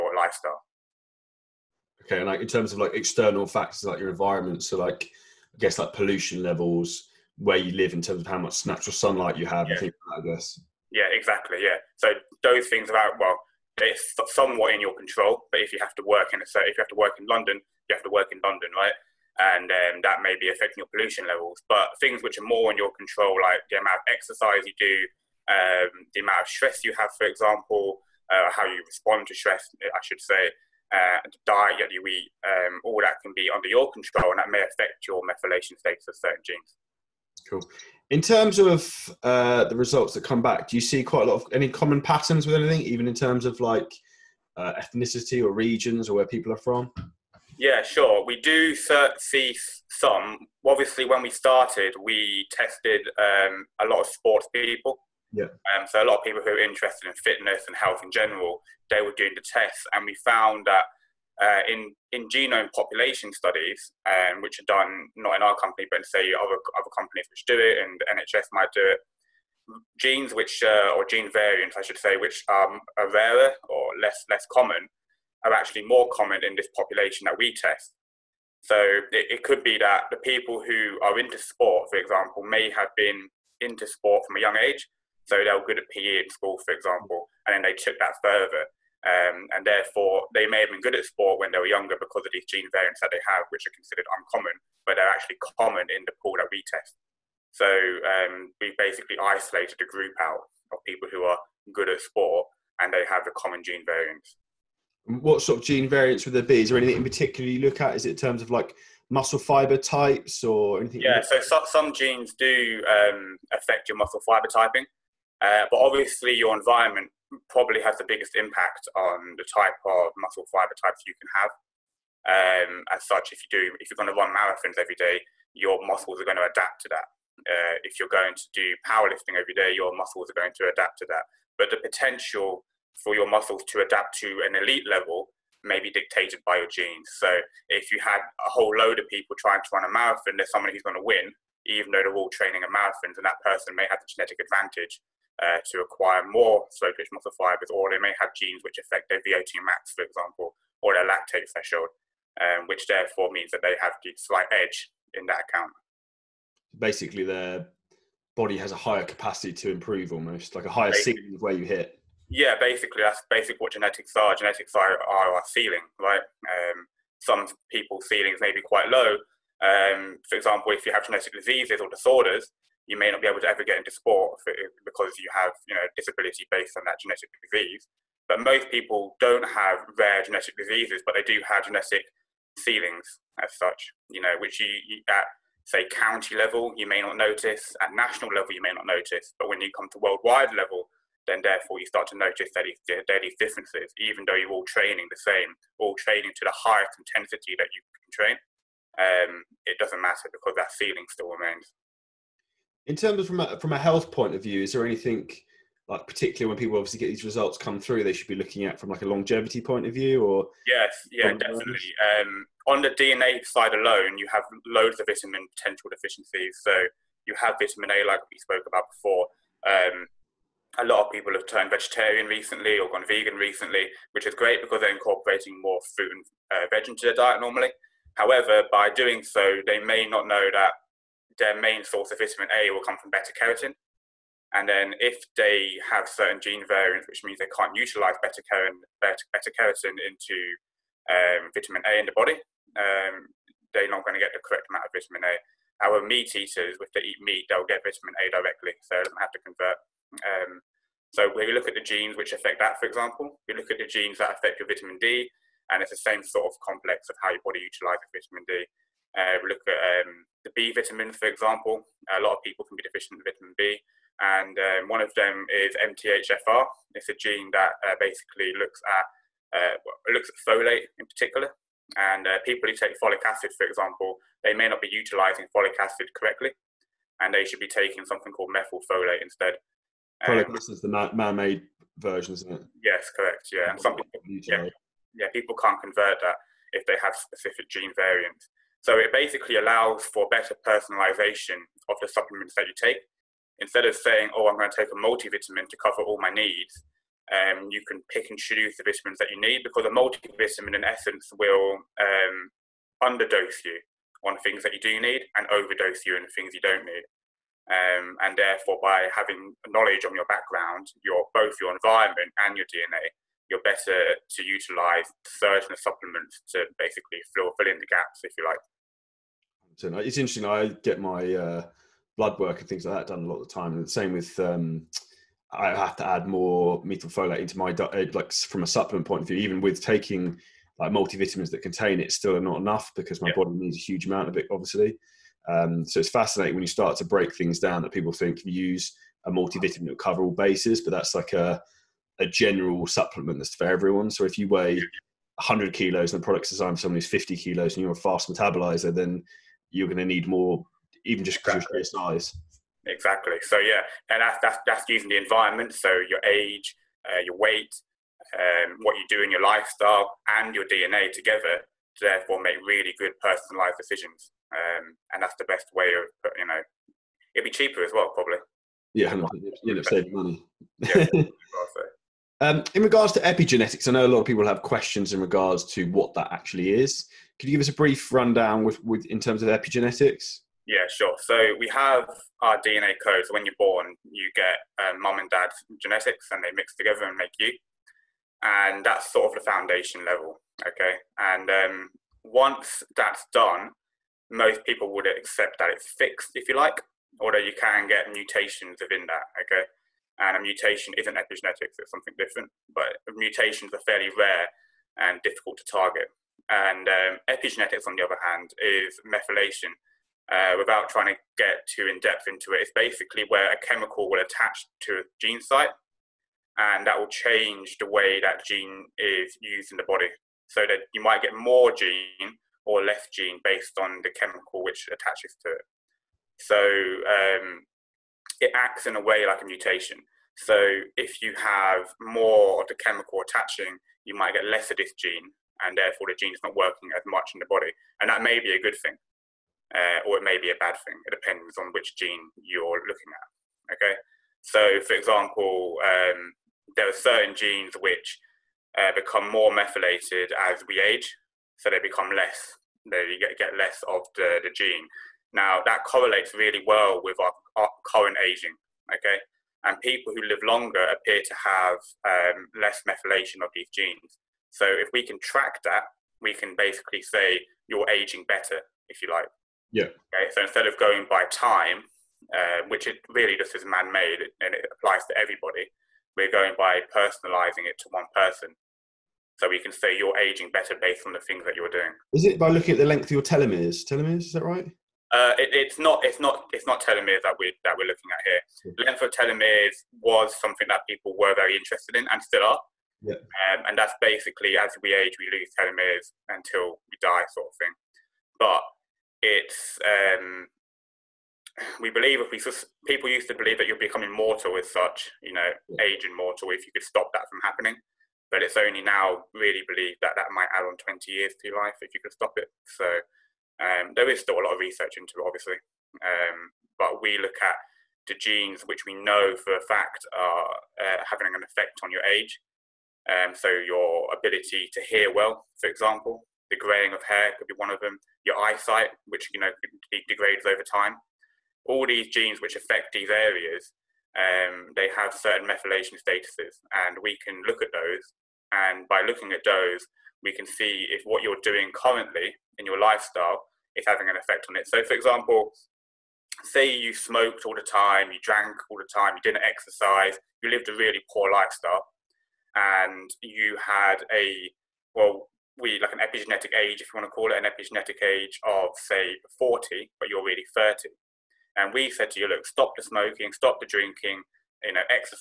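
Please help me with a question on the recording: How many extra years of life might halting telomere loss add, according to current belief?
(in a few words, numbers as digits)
20 years.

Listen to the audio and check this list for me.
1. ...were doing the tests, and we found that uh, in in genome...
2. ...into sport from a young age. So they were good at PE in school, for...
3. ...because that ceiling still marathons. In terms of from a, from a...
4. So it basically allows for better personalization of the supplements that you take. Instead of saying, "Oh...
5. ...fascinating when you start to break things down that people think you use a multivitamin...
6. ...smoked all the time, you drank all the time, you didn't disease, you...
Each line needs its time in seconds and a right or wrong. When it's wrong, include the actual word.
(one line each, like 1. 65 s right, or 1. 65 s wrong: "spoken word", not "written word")
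1. 59 s right
2. 83 s right
3. 200 s wrong: "remains", not "marathons"
4. 288 s right
5. 336 s right
6. 546 s wrong: "exercise", not "disease".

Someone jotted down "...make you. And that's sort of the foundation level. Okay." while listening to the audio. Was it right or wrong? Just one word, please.
right.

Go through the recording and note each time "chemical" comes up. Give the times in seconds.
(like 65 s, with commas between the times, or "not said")
413 s, 424 s, 432 s.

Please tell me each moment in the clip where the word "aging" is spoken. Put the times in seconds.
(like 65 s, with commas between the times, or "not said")
458 s, 467 s, 480 s.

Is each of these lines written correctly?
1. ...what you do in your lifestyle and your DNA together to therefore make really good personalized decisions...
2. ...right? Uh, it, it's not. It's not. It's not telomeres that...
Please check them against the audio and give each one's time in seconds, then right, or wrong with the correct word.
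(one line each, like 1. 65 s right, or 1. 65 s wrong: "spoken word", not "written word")
1. 358 s right
2. 484 s right.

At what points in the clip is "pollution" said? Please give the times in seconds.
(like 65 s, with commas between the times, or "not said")
5 s, 20 s.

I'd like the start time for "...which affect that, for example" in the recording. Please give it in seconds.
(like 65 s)
252 s.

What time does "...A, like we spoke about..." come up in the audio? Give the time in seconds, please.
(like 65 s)
217 s.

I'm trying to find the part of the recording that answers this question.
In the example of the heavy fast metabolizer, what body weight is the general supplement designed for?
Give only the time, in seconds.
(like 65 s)
347 s.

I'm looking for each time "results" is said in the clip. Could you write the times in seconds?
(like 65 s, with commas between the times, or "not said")
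39 s, 207 s.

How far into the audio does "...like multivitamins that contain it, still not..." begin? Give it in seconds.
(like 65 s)
330 s.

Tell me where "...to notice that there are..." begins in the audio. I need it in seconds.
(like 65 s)
192 s.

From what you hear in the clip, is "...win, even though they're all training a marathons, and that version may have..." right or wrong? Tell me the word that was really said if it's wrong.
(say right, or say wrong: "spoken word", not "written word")
wrong: "person", not "version".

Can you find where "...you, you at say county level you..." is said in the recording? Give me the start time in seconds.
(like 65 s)
184 s.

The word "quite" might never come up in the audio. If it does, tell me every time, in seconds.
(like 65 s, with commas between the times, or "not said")
41 s, 168 s.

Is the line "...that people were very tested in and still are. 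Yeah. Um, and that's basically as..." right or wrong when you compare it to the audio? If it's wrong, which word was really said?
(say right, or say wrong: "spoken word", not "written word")
wrong: "interested", not "tested".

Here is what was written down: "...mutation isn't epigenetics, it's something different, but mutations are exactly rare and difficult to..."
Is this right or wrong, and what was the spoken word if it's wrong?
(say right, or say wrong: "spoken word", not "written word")
wrong: "fairly", not "exactly".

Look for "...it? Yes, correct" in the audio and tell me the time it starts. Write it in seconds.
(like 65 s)
282 s.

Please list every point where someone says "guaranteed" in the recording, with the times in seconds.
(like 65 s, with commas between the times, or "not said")
not said.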